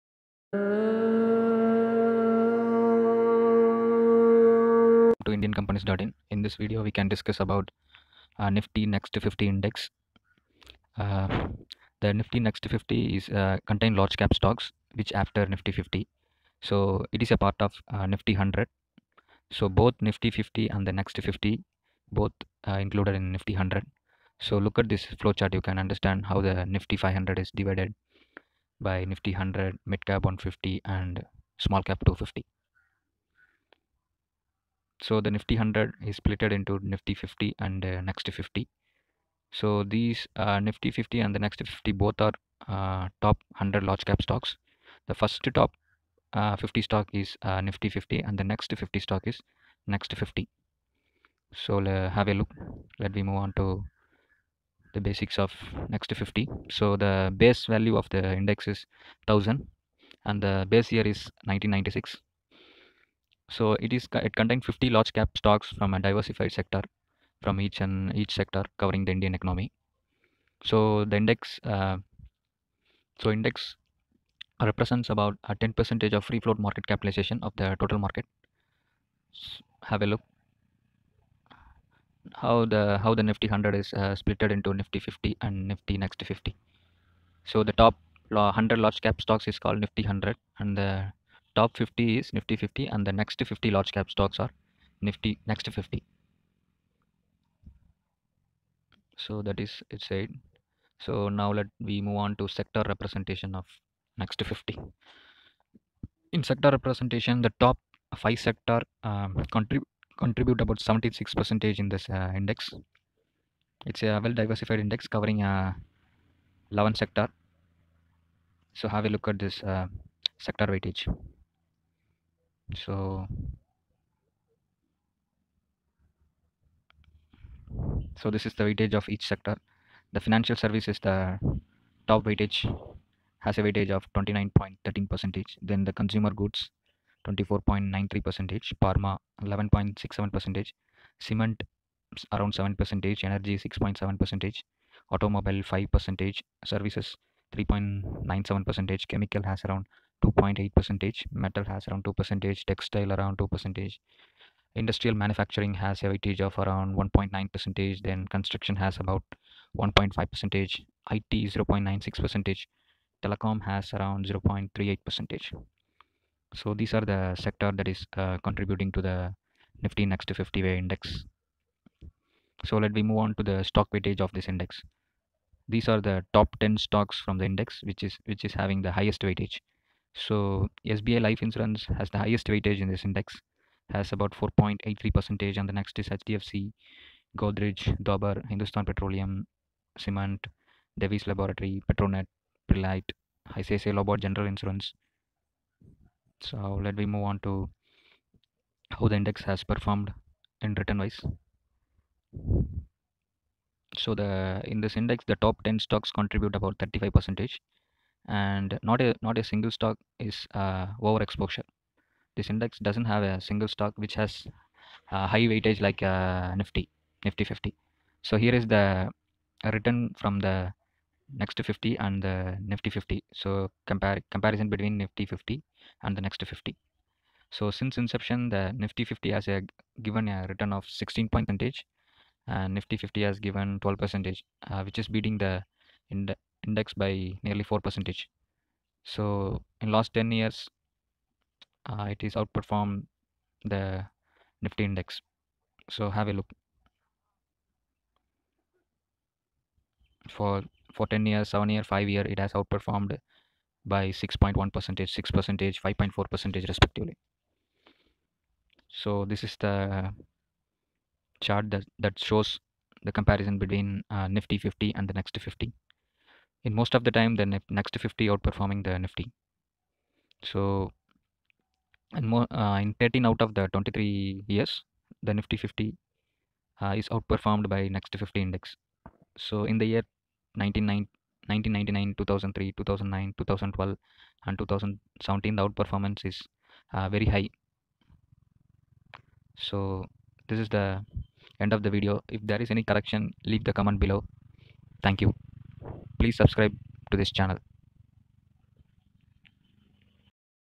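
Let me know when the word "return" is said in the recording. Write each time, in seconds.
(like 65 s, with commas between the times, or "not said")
200 s, 219 s, 230 s.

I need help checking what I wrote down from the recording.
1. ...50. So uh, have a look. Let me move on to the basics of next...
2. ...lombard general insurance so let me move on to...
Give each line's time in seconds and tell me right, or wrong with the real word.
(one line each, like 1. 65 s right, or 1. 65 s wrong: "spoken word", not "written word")
1. 50 s right
2. 193 s right.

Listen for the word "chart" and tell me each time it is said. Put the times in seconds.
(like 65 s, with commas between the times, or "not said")
25 s, 261 s.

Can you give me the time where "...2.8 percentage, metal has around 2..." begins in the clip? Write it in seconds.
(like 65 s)
150 s.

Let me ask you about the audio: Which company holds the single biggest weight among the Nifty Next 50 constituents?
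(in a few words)
SBI Life Insurance.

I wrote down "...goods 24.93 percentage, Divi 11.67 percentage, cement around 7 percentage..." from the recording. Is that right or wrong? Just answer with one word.
wrong.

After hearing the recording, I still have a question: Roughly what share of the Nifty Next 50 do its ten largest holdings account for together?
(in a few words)
35%.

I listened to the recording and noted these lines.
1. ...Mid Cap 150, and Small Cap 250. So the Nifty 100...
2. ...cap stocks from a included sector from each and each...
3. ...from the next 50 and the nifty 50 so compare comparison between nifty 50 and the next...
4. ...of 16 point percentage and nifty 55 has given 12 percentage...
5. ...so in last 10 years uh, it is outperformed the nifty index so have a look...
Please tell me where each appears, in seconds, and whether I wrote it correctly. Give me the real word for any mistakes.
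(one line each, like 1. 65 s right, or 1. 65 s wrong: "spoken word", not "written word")
1. 29 s right
2. 65 s wrong: "diversified", not "included"
3. 220 s right
4. 230 s wrong: "50", not "55"
5. 239 s right.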